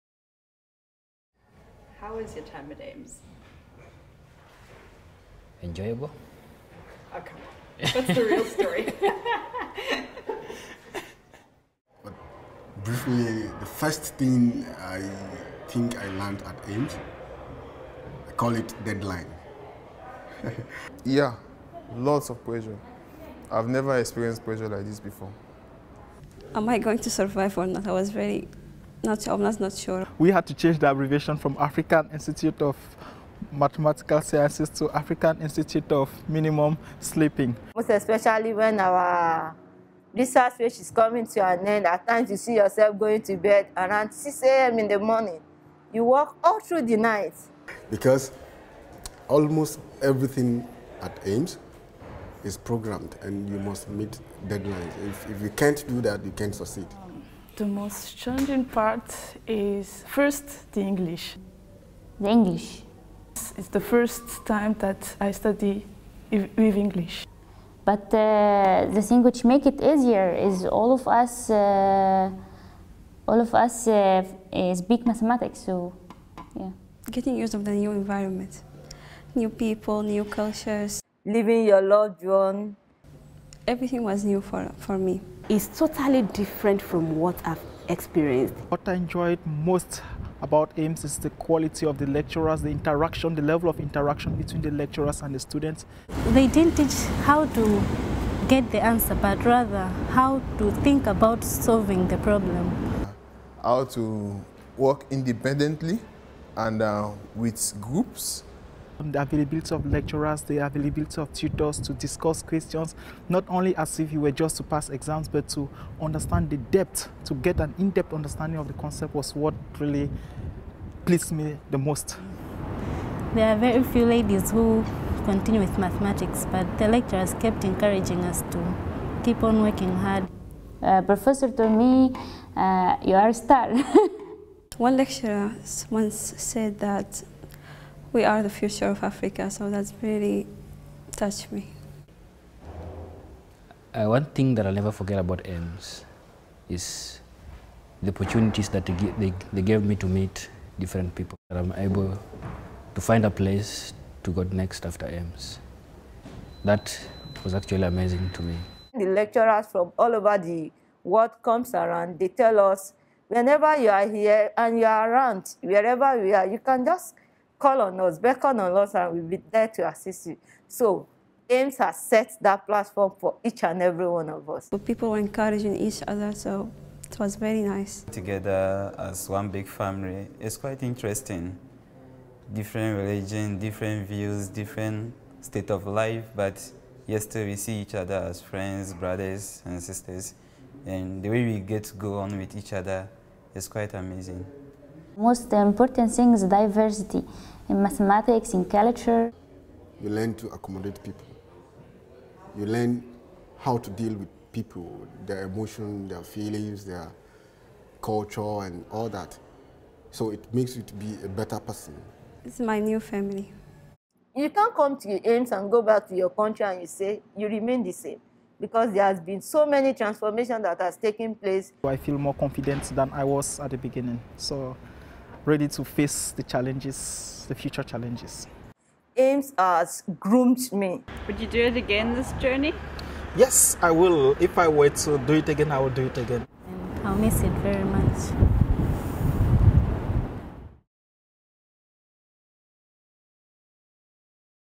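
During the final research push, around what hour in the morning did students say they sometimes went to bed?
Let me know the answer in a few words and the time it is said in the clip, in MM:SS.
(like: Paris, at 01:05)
6 a.m., at 00:44.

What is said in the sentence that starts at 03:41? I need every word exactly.
I feel more confident than I was at the beginning.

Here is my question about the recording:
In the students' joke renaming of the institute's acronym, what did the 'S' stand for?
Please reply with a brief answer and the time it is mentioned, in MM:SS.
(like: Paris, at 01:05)
Sleeping, at 00:36.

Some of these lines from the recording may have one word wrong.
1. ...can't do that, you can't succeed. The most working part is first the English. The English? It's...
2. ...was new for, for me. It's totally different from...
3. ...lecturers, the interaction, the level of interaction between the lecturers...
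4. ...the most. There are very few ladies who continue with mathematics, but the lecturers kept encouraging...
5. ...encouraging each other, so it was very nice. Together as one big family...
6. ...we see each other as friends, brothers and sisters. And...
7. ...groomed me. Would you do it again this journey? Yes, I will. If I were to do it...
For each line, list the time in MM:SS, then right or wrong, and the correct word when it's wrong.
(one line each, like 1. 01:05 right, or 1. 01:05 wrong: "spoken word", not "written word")
1. 00:55 wrong: "challenging", not "working"
2. 01:24 right
3. 01:32 right
4. 02:01 right
5. 02:55 right
6. 03:07 right
7. 03:50 right.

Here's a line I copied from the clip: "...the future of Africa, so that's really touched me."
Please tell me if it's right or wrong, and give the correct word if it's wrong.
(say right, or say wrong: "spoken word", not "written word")
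right.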